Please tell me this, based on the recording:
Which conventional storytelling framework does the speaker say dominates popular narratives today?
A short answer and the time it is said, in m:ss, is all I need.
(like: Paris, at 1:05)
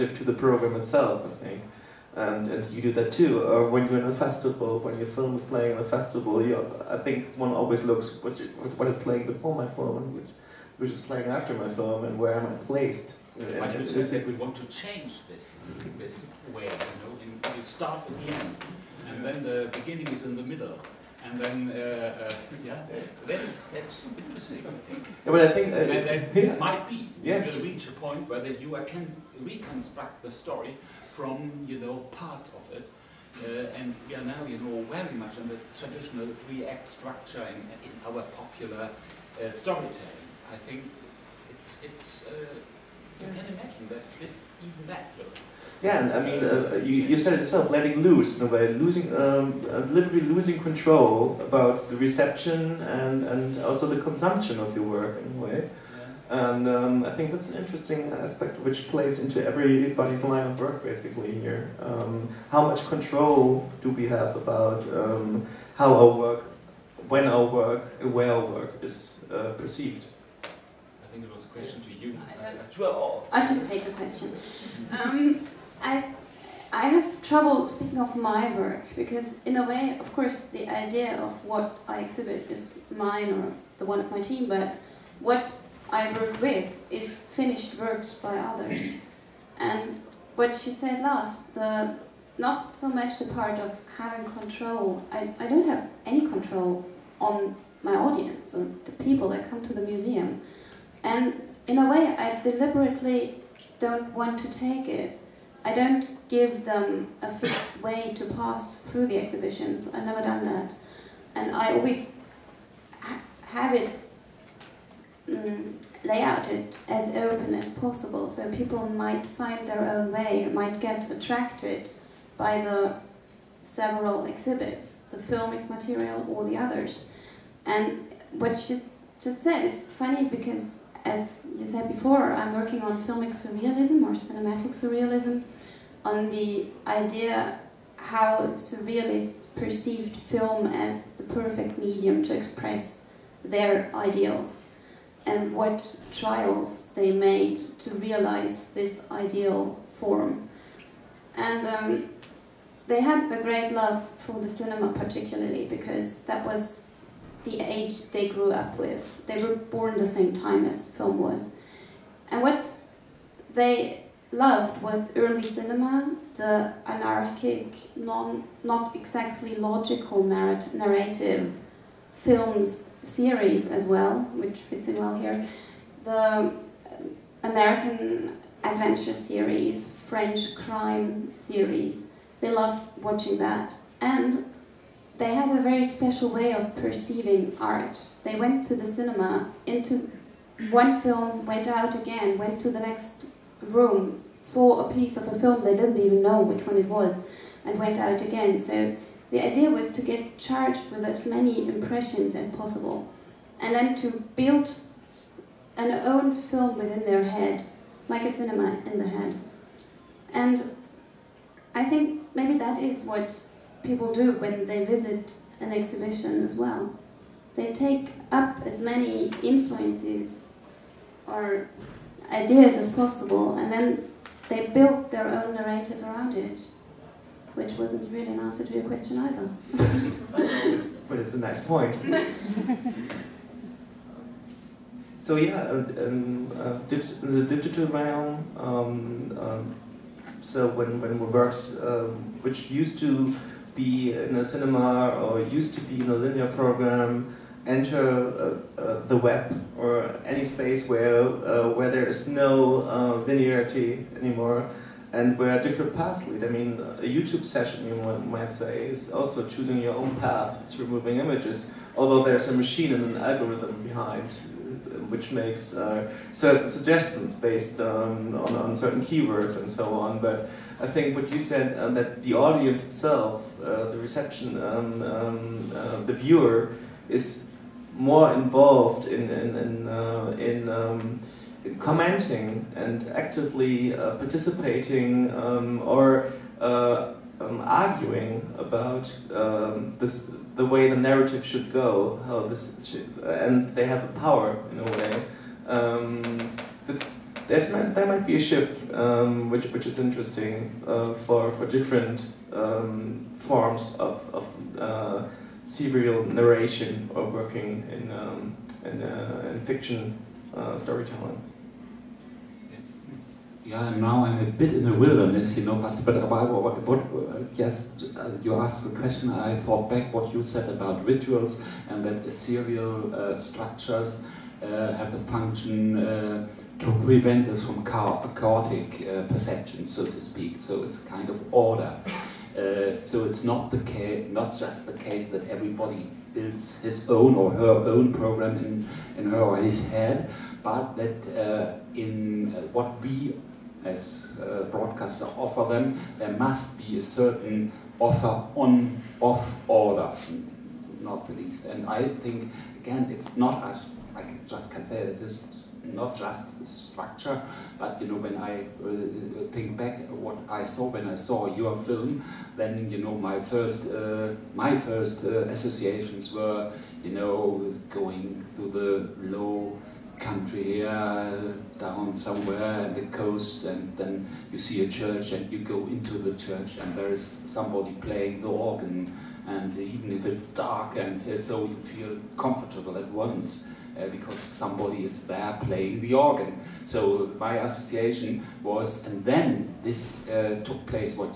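three act structure, at 0:36.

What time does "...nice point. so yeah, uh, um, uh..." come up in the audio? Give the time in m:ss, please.
3:51.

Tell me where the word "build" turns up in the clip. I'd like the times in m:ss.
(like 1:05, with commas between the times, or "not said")
3:24, 3:44, 5:36.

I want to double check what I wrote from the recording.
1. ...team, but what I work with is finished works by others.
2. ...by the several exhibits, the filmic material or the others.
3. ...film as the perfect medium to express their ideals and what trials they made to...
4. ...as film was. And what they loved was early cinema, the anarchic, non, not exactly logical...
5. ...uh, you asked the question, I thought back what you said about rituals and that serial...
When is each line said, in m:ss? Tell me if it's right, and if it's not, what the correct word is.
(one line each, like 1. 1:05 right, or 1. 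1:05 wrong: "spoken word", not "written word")
1. 1:24 right
2. 2:02 right
3. 2:20 right
4. 2:40 right
5. 5:18 right.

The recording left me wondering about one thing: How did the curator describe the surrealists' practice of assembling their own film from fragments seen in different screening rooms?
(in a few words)
a cinema in the head.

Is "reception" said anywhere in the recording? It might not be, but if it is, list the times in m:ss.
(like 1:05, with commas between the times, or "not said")
0:52, 4:33.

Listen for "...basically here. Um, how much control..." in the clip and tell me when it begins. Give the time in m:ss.
1:00.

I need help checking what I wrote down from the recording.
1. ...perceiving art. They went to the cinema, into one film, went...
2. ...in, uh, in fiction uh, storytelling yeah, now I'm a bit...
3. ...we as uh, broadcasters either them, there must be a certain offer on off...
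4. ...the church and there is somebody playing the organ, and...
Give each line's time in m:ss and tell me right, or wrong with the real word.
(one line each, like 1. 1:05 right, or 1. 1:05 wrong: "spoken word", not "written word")
1. 3:06 right
2. 5:08 right
3. 5:42 wrong: "offer", not "either"
4. 6:16 right.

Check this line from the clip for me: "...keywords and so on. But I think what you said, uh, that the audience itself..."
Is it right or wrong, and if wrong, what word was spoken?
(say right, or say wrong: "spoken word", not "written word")
right.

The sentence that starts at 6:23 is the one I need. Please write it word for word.
Uh, because somebody is there playing the organ.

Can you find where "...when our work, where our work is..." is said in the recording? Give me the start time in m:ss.
1:07.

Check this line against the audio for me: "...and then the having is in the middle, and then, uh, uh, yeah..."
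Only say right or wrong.
wrong.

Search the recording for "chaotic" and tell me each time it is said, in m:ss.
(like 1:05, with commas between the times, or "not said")
5:28.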